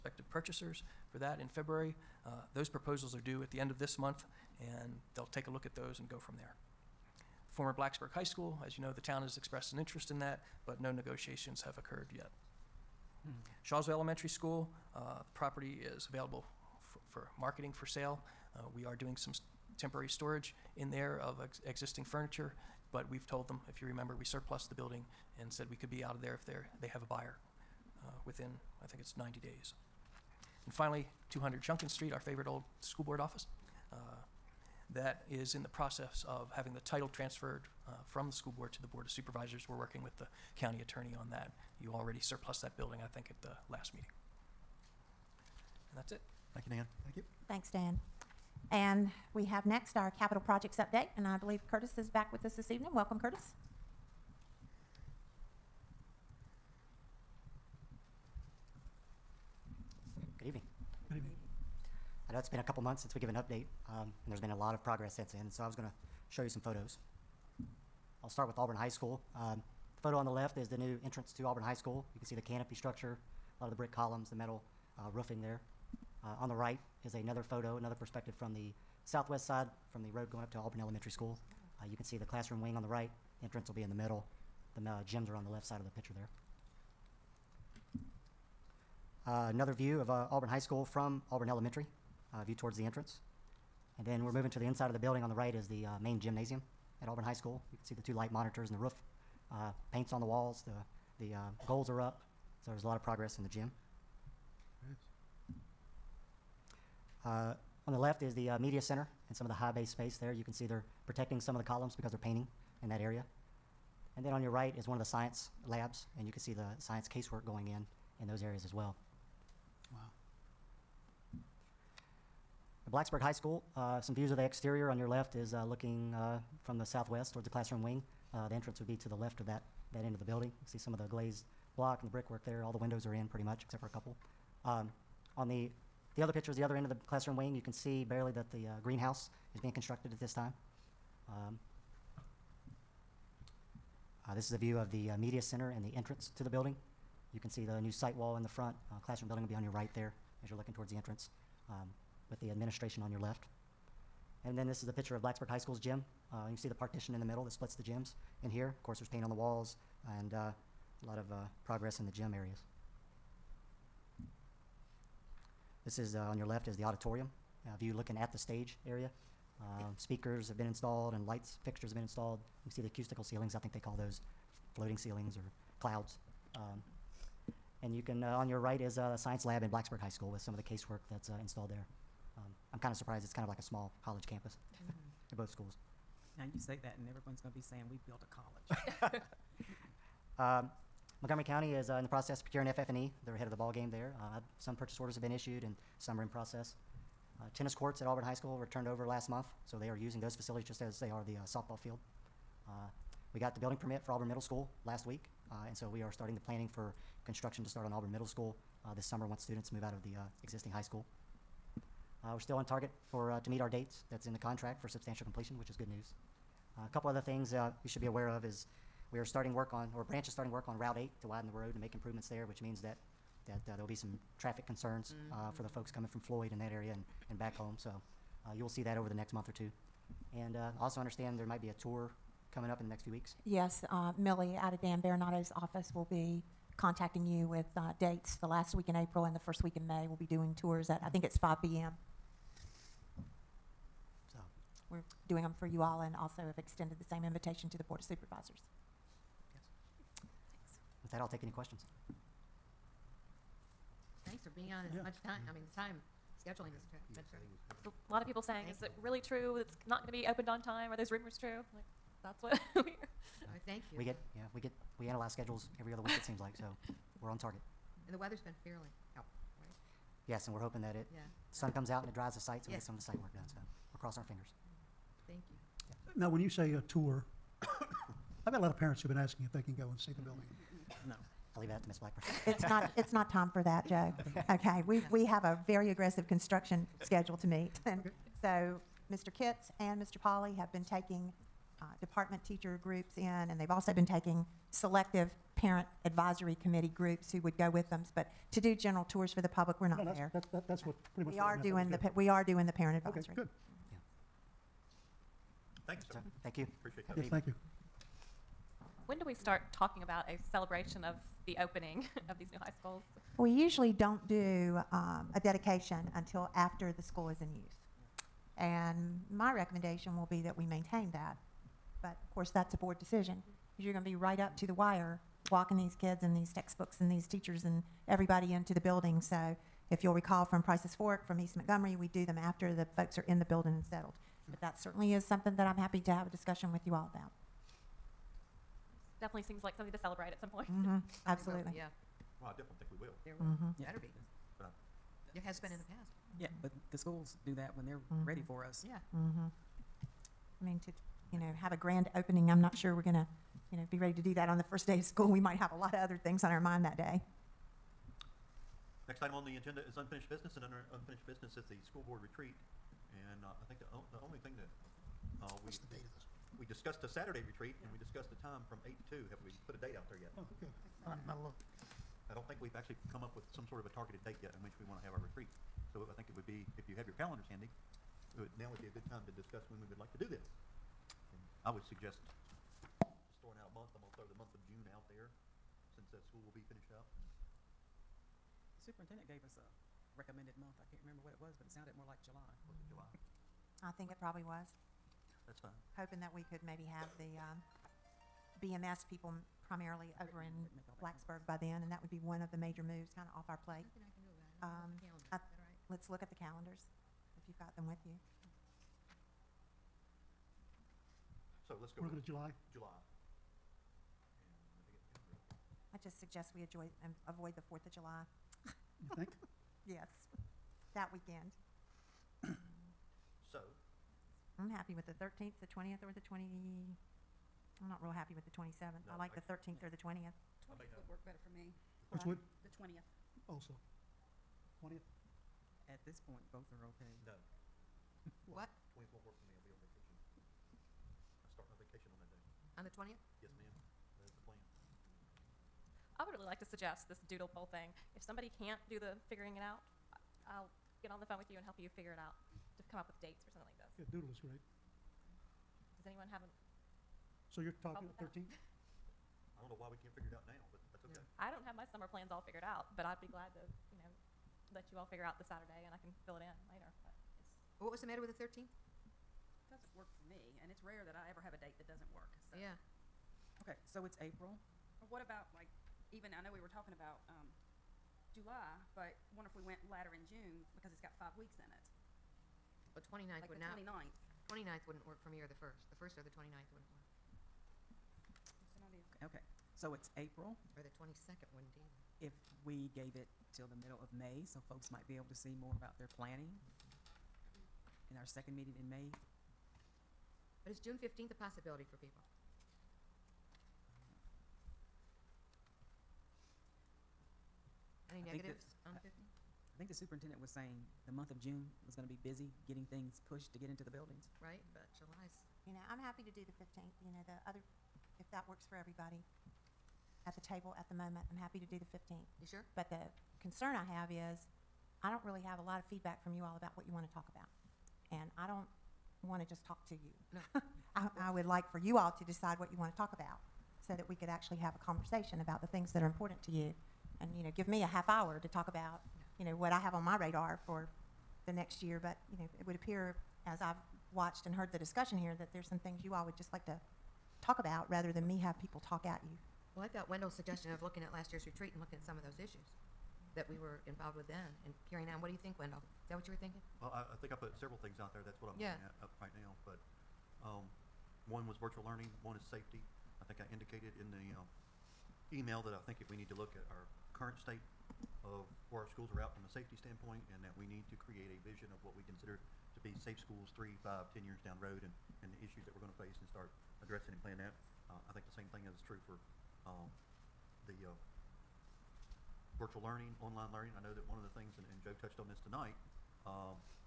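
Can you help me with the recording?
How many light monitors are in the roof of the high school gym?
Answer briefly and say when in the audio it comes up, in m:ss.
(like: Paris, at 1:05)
2, at 1:37.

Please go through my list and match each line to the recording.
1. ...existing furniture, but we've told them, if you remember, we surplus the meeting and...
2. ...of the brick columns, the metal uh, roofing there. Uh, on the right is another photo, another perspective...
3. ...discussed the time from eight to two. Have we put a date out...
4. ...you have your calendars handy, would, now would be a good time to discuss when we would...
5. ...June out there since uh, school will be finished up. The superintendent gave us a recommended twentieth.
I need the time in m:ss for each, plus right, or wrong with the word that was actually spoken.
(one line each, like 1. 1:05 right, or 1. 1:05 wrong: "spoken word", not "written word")
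1. 0:21 wrong: "building", not "meeting"
2. 1:13 right
3. 6:07 right
4. 6:16 right
5. 6:24 wrong: "month", not "twentieth".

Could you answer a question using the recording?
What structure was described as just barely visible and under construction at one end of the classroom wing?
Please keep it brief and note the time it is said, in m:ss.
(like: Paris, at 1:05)
Greenhouse, at 2:18.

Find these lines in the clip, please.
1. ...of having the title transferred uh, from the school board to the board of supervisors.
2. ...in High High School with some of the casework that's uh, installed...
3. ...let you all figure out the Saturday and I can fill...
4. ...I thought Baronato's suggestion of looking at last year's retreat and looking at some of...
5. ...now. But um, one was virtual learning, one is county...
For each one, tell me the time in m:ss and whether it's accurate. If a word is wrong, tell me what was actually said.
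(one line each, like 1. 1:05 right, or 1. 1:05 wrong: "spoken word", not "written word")
1. 0:36 right
2. 2:59 wrong: "Blacksburg", not "High"
3. 7:44 right
4. 9:09 wrong: "Wendell", not "Baronato"
5. 9:19 wrong: "safety", not "county".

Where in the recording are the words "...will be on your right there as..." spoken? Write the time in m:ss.
2:29.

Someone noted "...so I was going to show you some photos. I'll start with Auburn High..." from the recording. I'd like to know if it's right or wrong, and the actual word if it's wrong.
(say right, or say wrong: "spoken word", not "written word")
right.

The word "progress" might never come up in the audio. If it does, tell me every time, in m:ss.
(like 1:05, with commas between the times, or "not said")
1:04, 1:43, 2:41.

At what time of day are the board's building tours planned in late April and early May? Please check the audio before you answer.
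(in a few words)
5 p.m.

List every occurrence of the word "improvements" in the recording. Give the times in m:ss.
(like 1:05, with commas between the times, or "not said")
3:41.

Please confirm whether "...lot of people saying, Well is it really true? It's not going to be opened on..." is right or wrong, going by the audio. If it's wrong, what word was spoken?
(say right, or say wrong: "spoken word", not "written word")
wrong: "Thank", not "Well".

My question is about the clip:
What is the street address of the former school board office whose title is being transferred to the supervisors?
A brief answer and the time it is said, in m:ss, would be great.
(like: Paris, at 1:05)
200 Junkin Street, at 0:31.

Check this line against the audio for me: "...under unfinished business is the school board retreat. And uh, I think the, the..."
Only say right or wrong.
right.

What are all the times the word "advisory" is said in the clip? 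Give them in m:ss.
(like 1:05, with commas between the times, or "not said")
4:56, 5:03.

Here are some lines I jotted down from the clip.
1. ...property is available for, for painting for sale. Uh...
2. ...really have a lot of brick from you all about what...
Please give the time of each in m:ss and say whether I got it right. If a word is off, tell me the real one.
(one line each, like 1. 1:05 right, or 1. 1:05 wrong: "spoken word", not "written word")
1. 0:15 wrong: "marketing", not "painting"
2. 8:45 wrong: "feedback", not "brick".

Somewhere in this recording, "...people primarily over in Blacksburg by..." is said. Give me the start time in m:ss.
6:39.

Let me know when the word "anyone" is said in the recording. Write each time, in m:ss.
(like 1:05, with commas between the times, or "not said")
7:36.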